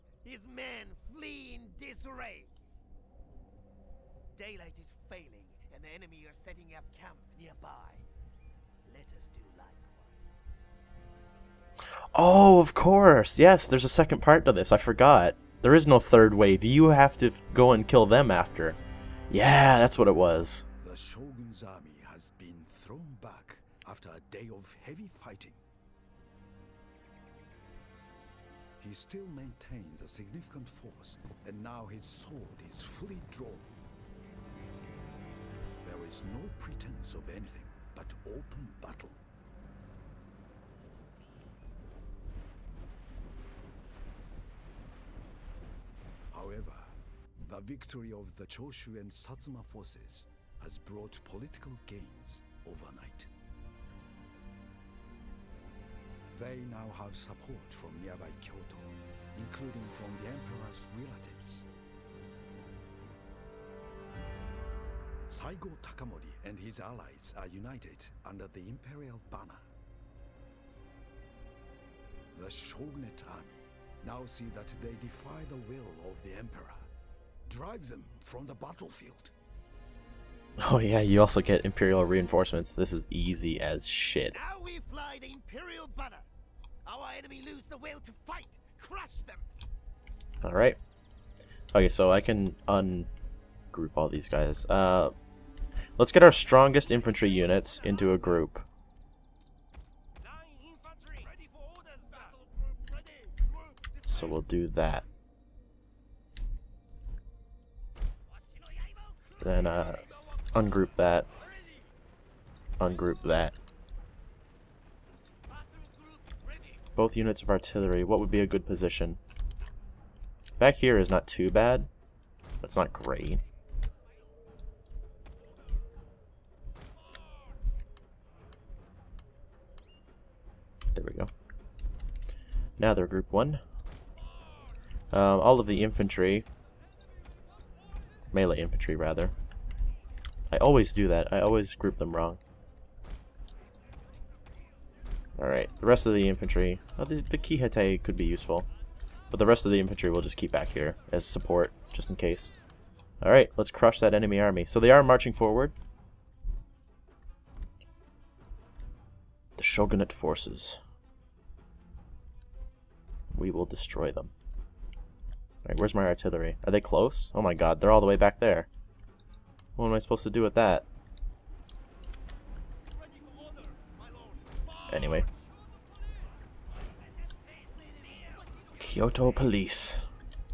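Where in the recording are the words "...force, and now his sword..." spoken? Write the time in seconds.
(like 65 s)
30 s.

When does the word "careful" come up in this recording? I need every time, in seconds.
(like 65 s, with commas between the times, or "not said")
not said.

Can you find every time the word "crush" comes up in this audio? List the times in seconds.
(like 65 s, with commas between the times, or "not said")
88 s, 153 s.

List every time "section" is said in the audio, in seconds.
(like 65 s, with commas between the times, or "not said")
not said.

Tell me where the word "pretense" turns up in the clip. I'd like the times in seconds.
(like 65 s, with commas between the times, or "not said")
36 s.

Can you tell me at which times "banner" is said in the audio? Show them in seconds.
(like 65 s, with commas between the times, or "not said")
69 s, 85 s.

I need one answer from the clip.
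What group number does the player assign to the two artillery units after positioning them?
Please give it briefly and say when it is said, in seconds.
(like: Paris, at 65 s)
1, at 133 s.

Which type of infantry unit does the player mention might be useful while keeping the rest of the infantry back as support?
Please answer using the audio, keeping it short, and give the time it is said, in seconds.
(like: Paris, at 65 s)
Kihete, at 147 s.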